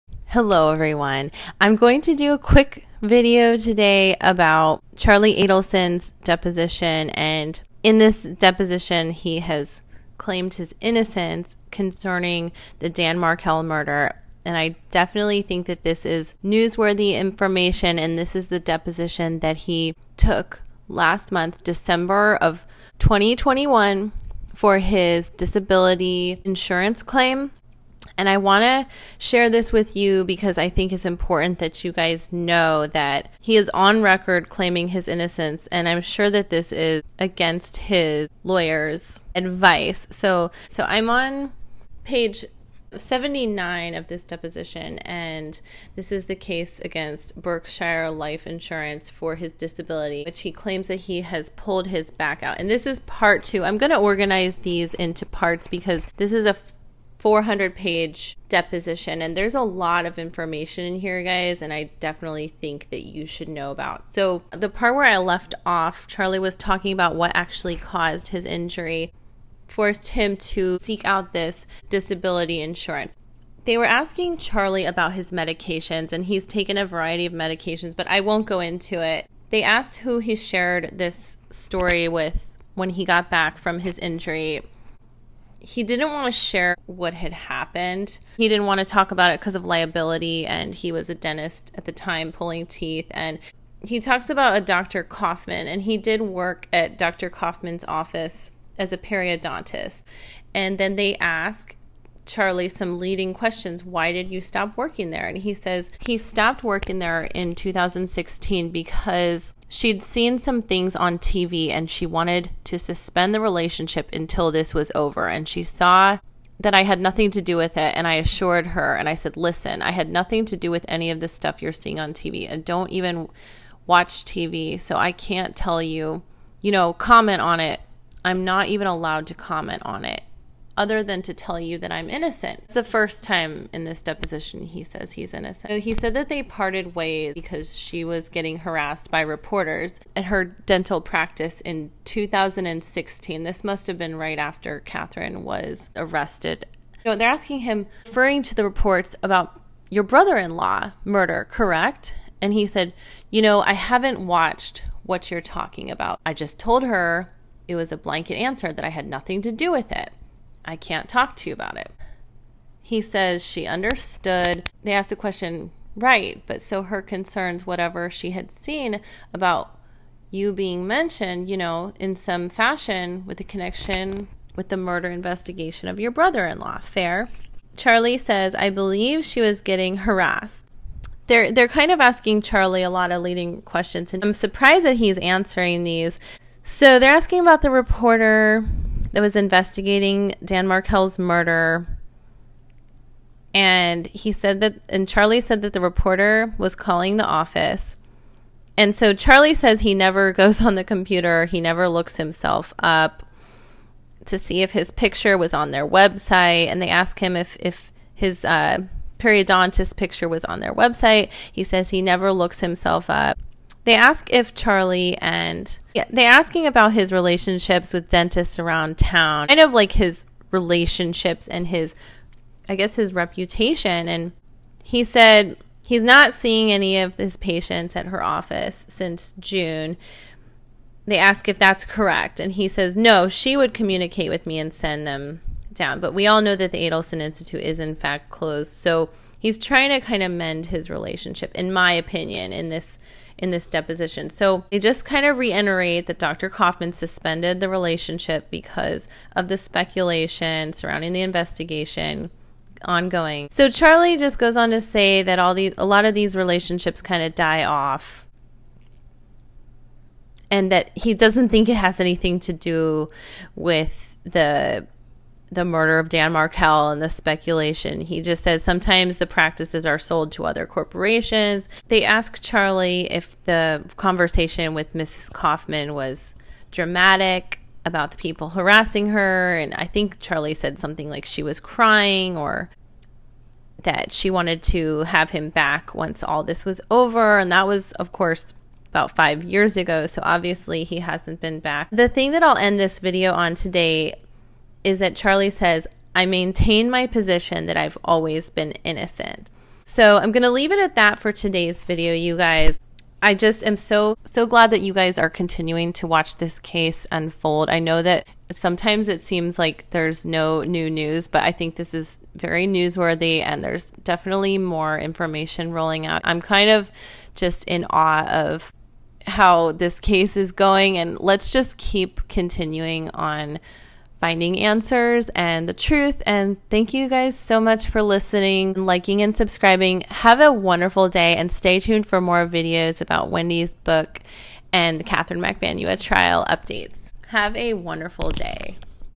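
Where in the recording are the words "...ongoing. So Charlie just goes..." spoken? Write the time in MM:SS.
04:12.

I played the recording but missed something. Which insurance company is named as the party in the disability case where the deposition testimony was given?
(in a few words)
Berkshire Life Insurance.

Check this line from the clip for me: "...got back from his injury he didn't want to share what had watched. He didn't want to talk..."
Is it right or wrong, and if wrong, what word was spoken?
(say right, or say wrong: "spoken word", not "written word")
wrong: "happened", not "watched".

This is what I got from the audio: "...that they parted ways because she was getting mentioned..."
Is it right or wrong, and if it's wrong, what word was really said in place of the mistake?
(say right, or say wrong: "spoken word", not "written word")
wrong: "harassed", not "mentioned".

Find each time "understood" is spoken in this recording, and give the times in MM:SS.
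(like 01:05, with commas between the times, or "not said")
02:43.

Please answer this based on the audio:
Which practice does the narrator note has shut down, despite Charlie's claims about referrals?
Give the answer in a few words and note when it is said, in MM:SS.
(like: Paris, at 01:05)
Adelson Institute, at 03:56.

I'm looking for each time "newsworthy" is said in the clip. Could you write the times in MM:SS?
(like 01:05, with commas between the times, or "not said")
00:16, 05:12.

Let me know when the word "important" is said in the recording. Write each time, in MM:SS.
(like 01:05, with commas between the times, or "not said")
00:31.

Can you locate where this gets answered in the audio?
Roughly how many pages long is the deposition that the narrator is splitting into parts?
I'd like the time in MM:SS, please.
00:57.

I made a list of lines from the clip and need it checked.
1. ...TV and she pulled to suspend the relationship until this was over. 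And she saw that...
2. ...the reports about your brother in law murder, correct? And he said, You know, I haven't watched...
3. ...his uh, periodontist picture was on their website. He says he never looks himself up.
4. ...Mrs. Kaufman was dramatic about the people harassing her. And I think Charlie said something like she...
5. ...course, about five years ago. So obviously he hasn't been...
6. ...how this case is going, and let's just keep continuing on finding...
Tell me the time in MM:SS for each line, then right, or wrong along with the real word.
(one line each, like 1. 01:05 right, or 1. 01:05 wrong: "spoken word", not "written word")
1. 01:51 wrong: "wanted", not "pulled"
2. 02:28 right
3. 03:28 right
4. 04:34 right
5. 04:48 right
6. 05:19 right.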